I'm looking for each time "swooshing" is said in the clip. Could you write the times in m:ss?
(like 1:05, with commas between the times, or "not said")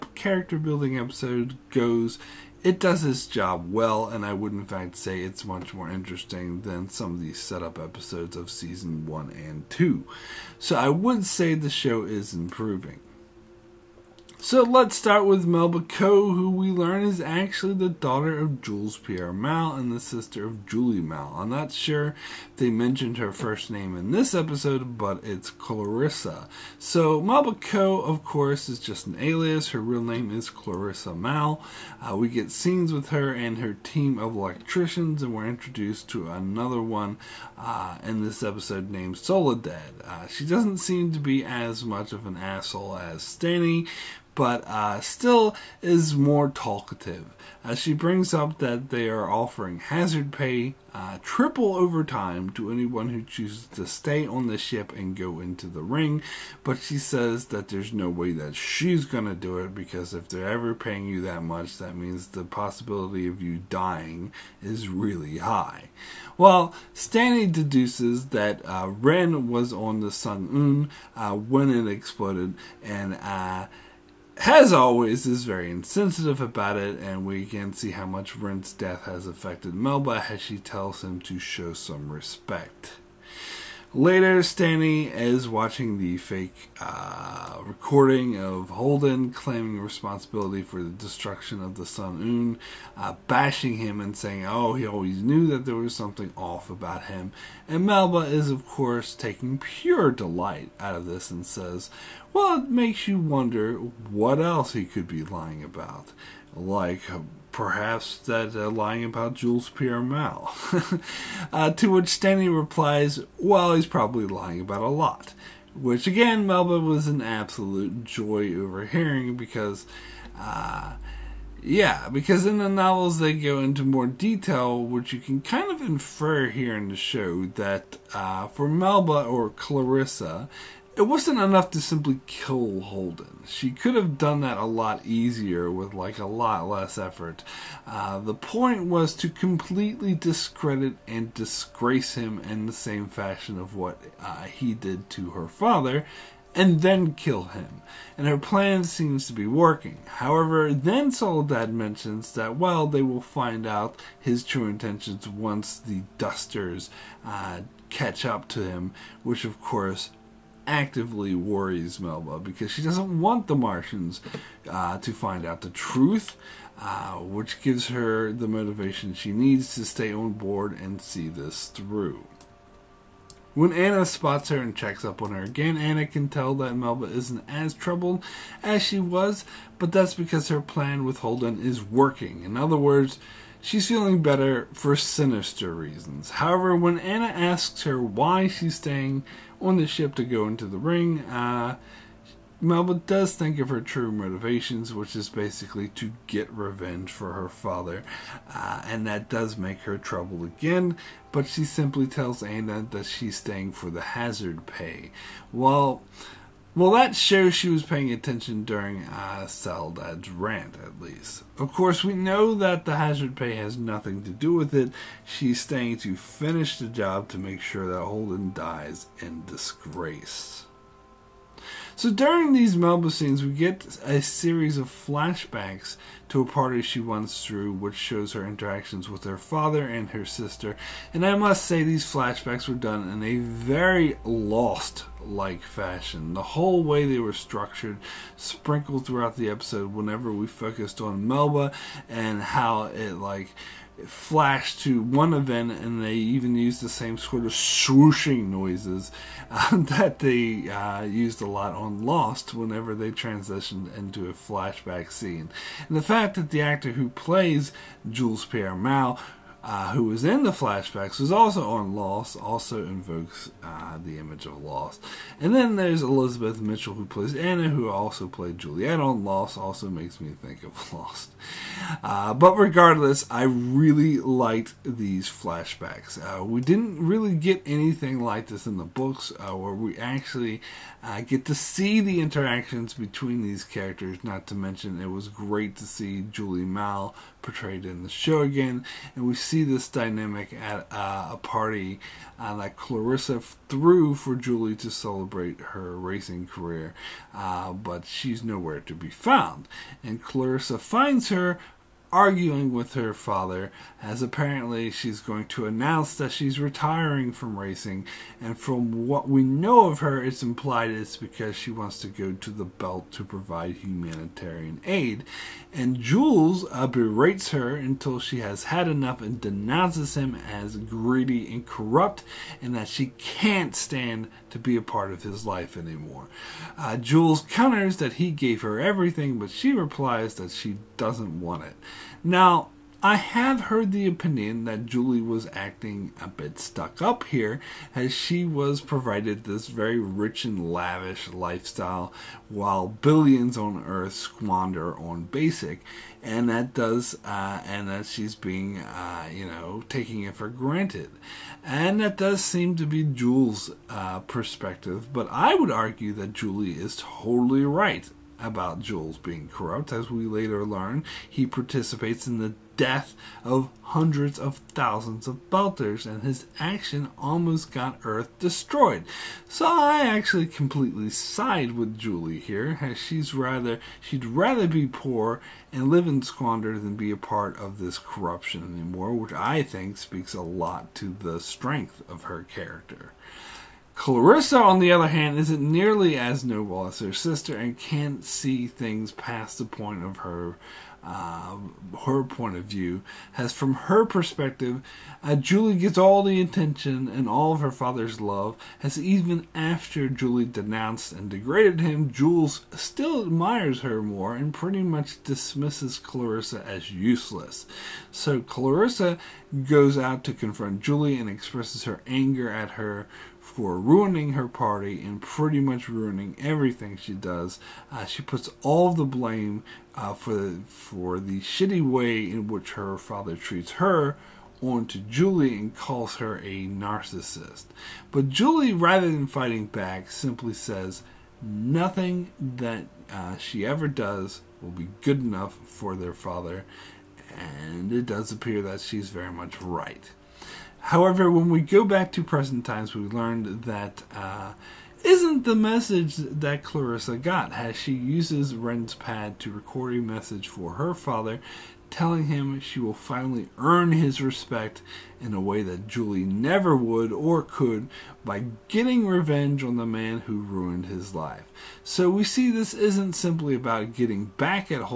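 4:07.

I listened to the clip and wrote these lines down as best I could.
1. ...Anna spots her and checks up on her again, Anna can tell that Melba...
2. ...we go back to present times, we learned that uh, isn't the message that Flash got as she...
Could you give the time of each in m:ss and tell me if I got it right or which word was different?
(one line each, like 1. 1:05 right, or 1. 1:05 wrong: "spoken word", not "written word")
1. 2:53 right
2. 7:21 wrong: "Clarissa", not "Flash".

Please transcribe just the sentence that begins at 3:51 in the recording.
And I must say, these flashbacks were done in a very lost like fashion.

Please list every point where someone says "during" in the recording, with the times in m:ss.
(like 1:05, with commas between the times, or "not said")
3:28, 3:42.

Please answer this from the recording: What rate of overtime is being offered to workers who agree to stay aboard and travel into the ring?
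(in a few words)
Triple overtime.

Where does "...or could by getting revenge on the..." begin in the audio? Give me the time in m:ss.
7:37.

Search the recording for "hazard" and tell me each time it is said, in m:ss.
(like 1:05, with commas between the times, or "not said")
0:49, 3:24, 3:32.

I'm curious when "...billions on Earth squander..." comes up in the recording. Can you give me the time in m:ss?
5:42.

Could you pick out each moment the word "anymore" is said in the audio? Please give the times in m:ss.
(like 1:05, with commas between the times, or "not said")
5:25, 6:18.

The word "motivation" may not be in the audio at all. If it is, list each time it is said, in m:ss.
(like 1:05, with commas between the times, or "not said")
2:48, 3:14.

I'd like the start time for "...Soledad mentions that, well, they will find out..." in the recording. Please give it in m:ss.
2:31.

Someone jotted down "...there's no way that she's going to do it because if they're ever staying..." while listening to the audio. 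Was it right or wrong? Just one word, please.
wrong.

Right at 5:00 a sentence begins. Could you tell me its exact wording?
And Clarissa finds her, arguing with her father, as apparently she's going to announce that she's retiring from racing.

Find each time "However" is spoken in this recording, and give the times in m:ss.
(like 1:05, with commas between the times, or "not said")
2:30, 3:06, 7:20.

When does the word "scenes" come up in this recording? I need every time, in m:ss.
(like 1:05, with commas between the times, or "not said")
0:32, 3:43, 4:15.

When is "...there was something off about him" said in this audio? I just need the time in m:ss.
1:35.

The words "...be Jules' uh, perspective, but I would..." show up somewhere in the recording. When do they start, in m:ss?
5:52.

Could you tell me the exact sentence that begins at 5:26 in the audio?
Uh, Jules counters that he gave her everything, but she replies that she doesn't want it.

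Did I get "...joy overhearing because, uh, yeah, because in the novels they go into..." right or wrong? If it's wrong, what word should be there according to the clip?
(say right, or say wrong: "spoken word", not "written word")
right.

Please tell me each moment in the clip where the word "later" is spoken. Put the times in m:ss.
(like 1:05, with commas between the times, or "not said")
1:23, 6:00.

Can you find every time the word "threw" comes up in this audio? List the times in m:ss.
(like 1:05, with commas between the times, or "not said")
3:47, 4:53.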